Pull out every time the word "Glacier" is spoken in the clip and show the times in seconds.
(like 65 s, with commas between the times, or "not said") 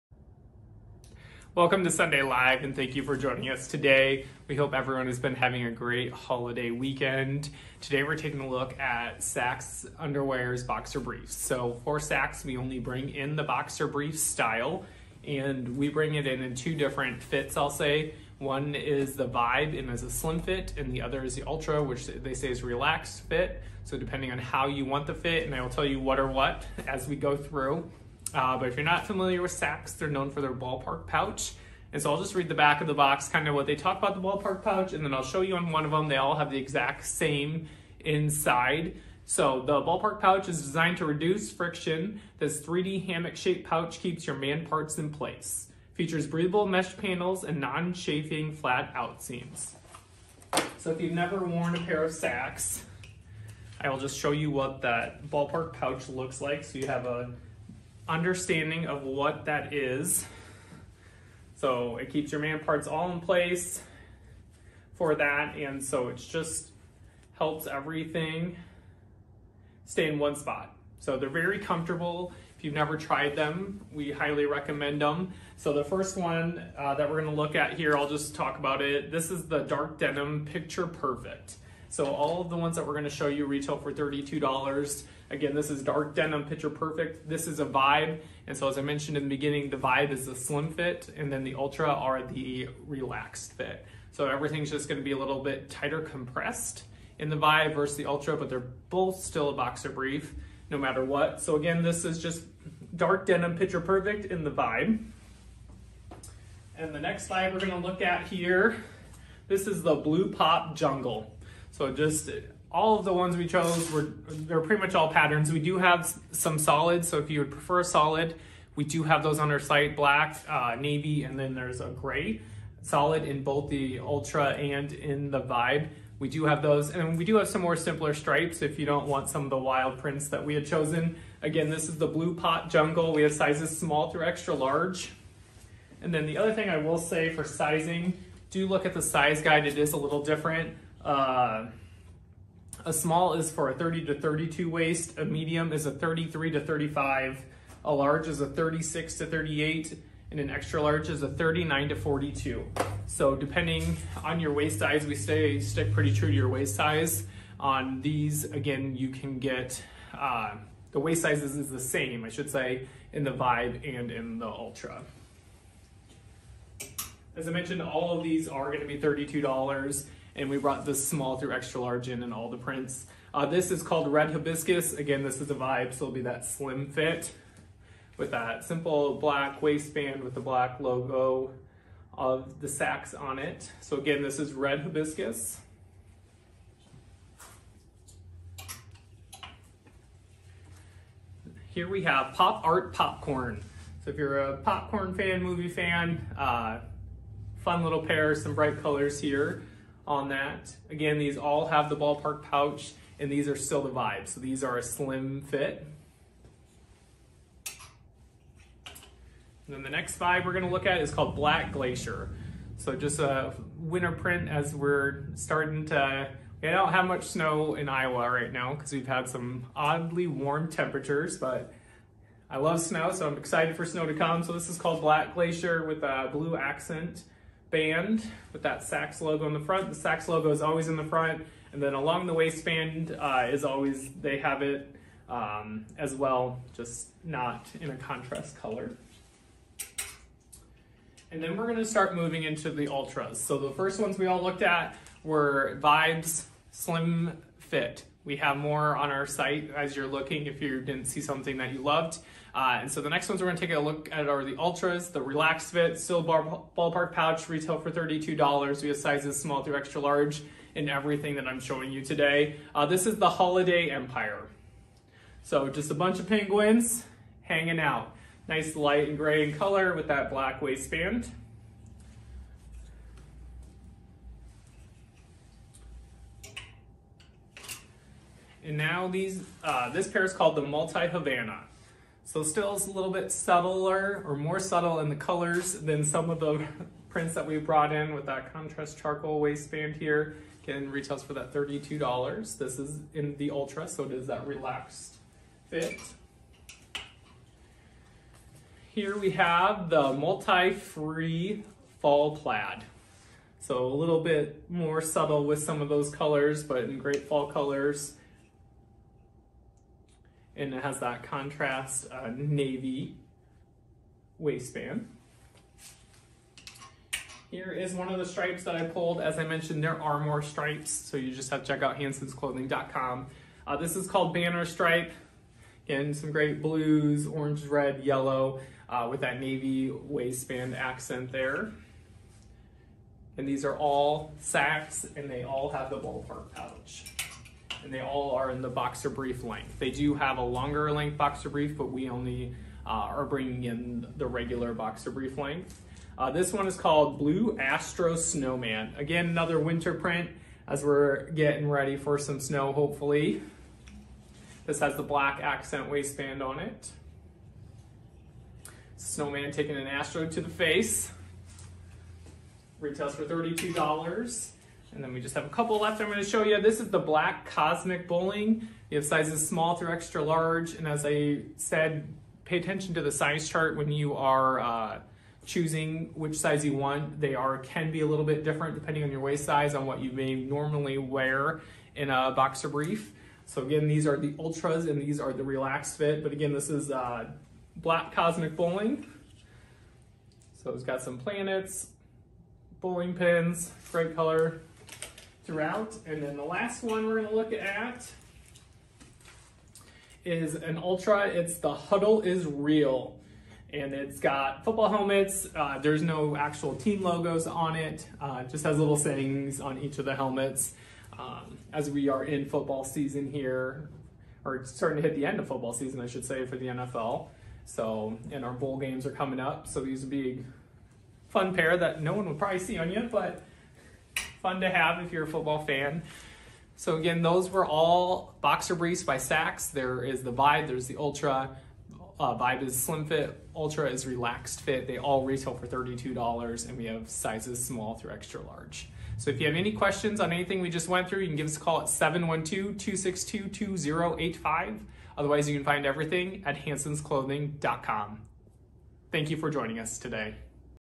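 211 s, 225 s.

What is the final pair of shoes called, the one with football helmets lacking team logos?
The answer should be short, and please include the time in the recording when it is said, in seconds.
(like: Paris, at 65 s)
The Huddle is Real, at 401 s.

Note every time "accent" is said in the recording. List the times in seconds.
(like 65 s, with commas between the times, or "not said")
226 s, 330 s, 355 s.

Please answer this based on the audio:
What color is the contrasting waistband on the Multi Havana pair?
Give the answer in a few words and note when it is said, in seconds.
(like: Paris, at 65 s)
charcoal, at 288 s.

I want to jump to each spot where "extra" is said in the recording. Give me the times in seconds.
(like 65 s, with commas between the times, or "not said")
134 s, 150 s, 171 s, 259 s, 369 s, 438 s.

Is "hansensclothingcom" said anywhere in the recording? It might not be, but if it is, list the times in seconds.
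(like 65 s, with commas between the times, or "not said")
321 s, 446 s.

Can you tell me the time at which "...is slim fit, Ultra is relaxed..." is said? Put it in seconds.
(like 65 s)
432 s.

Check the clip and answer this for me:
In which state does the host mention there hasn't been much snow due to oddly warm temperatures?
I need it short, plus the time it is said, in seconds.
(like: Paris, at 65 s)
Iowa, at 217 s.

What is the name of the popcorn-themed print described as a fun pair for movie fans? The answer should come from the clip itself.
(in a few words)
Pop Art Popcorn.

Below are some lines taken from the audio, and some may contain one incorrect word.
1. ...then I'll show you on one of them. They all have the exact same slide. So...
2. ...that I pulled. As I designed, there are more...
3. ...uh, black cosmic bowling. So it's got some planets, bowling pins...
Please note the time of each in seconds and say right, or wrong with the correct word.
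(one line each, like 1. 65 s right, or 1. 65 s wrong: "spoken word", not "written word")
1. 35 s wrong: "inside", not "slide"
2. 318 s wrong: "mentioned", not "designed"
3. 386 s right.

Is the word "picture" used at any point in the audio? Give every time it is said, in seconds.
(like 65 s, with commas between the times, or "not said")
80 s, 86 s, 103 s.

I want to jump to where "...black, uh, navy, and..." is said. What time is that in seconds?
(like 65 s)
119 s.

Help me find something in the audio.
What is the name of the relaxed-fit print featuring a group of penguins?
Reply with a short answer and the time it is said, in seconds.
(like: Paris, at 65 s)
Holiday Empire, at 263 s.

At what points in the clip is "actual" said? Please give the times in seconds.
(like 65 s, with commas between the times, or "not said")
406 s.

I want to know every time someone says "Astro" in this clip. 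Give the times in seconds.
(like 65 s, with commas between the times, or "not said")
347 s, 359 s.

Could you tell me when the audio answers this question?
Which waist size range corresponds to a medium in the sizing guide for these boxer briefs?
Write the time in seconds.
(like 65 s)
145 s.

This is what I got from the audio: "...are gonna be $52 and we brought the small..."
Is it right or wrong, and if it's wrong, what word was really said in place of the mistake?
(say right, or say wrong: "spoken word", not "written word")
wrong: "32", not "52".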